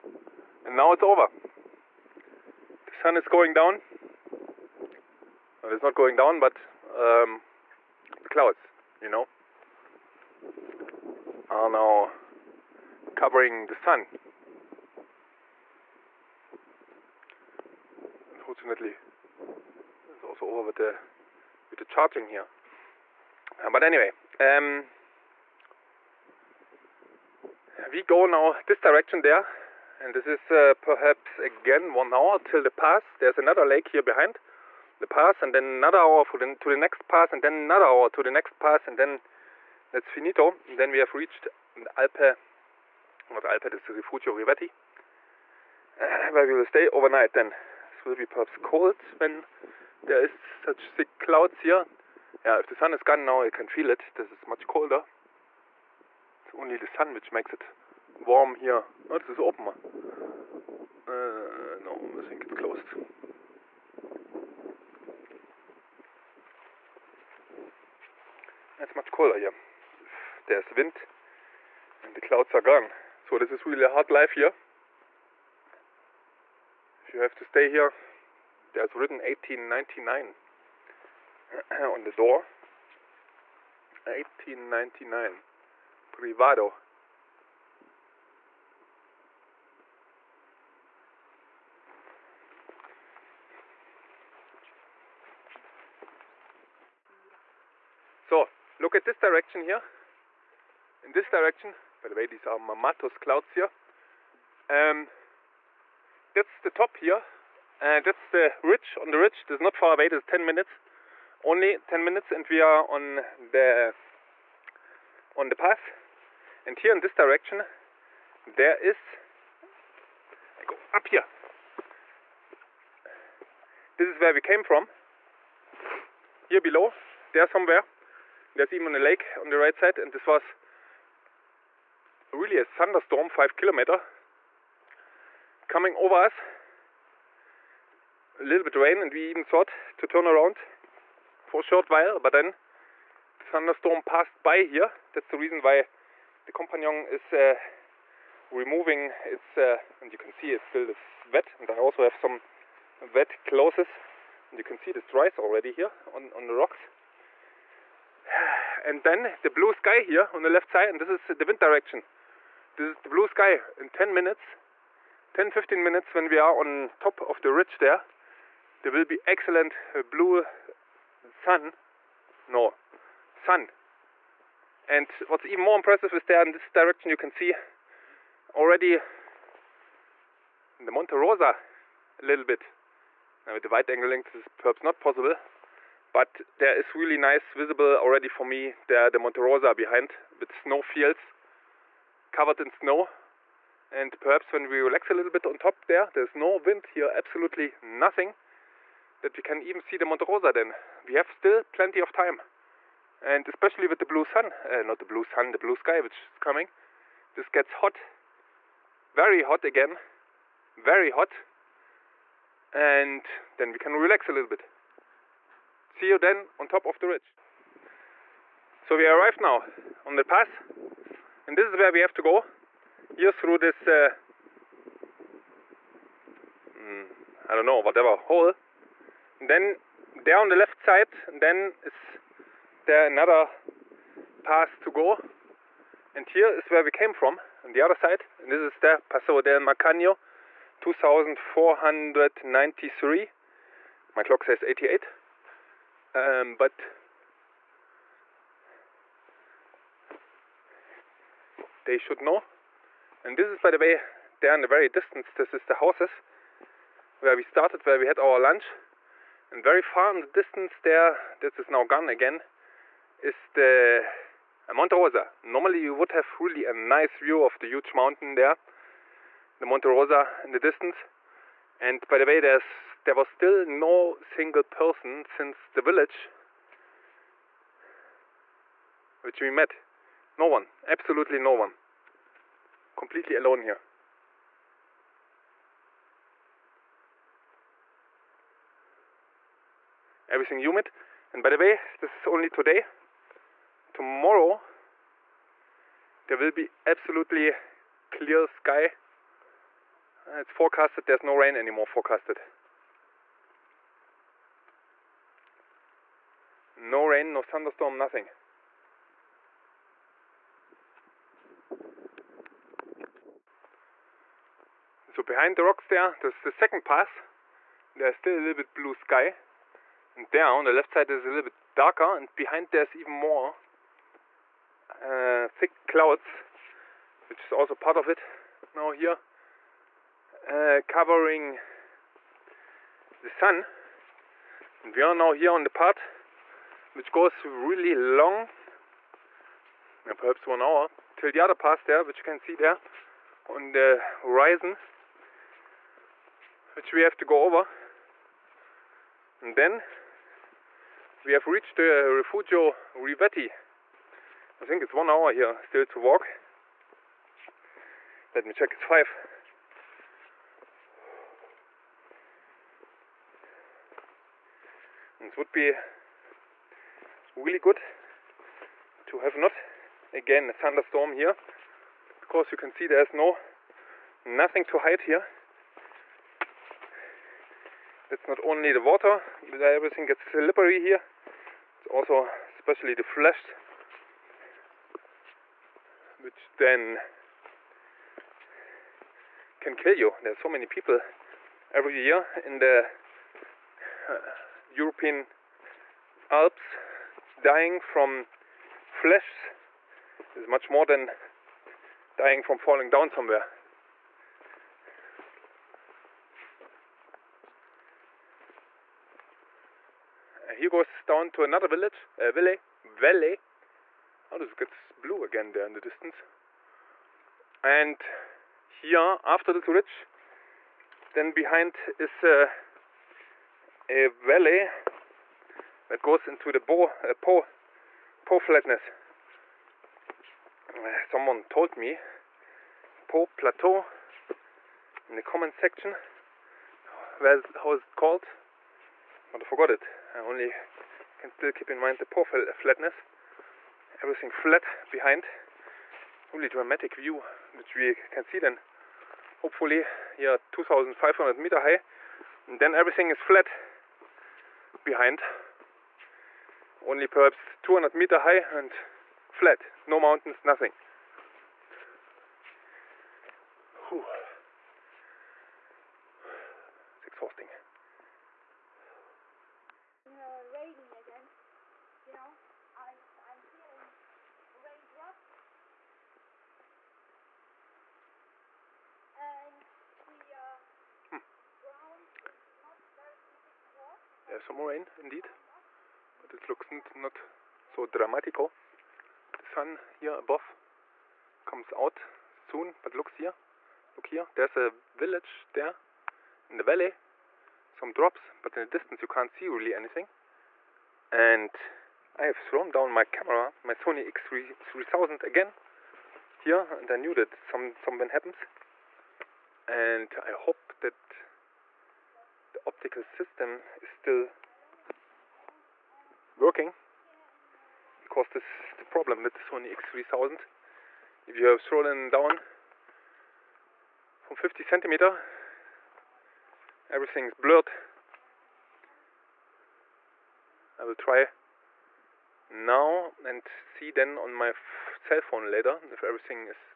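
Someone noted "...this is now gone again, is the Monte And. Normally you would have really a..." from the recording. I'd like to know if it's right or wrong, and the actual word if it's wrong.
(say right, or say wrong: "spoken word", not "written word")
wrong: "Rosa", not "And".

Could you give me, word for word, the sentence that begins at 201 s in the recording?
We have still plenty of time.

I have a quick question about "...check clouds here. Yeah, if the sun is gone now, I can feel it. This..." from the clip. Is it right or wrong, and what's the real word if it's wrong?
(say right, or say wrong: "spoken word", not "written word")
wrong: "thick", not "check".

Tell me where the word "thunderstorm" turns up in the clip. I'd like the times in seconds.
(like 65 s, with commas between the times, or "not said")
132 s, 143 s, 307 s, 370 s.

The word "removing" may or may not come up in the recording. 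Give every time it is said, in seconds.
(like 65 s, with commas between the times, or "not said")
148 s.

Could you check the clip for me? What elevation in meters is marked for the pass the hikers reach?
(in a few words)
2493.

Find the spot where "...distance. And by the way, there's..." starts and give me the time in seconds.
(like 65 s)
270 s.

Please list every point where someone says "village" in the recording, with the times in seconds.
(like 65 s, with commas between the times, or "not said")
275 s, 411 s, 494 s.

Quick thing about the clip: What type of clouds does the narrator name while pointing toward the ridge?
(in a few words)
Mamatos clouds.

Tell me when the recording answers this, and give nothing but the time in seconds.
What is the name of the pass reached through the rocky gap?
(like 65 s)
239 s.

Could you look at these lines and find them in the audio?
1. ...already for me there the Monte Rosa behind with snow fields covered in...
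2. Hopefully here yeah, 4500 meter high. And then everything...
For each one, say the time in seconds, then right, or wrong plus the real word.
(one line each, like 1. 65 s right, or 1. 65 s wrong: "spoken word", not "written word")
1. 187 s right
2. 449 s wrong: "2500", not "4500".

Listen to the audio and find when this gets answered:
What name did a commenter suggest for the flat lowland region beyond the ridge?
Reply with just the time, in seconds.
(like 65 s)
433 s.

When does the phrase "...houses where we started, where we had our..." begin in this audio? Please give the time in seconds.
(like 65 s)
255 s.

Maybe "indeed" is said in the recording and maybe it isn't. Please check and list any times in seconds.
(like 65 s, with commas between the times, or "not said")
484 s.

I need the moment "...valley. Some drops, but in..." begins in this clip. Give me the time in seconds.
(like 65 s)
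496 s.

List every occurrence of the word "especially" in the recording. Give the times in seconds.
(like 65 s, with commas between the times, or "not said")
203 s, 382 s.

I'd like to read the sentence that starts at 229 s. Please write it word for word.
And then there on the left side, then is there er another pass to go.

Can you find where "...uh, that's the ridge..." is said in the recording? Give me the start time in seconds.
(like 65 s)
108 s.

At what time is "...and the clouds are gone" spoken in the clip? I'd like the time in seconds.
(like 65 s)
72 s.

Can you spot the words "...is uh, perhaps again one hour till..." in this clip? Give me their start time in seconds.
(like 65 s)
30 s.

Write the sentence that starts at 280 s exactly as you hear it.
No one, absolutely no one completely alone here.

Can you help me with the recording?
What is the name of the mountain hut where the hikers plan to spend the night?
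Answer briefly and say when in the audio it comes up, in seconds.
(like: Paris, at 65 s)
Rifugio Rivetti, at 43 s.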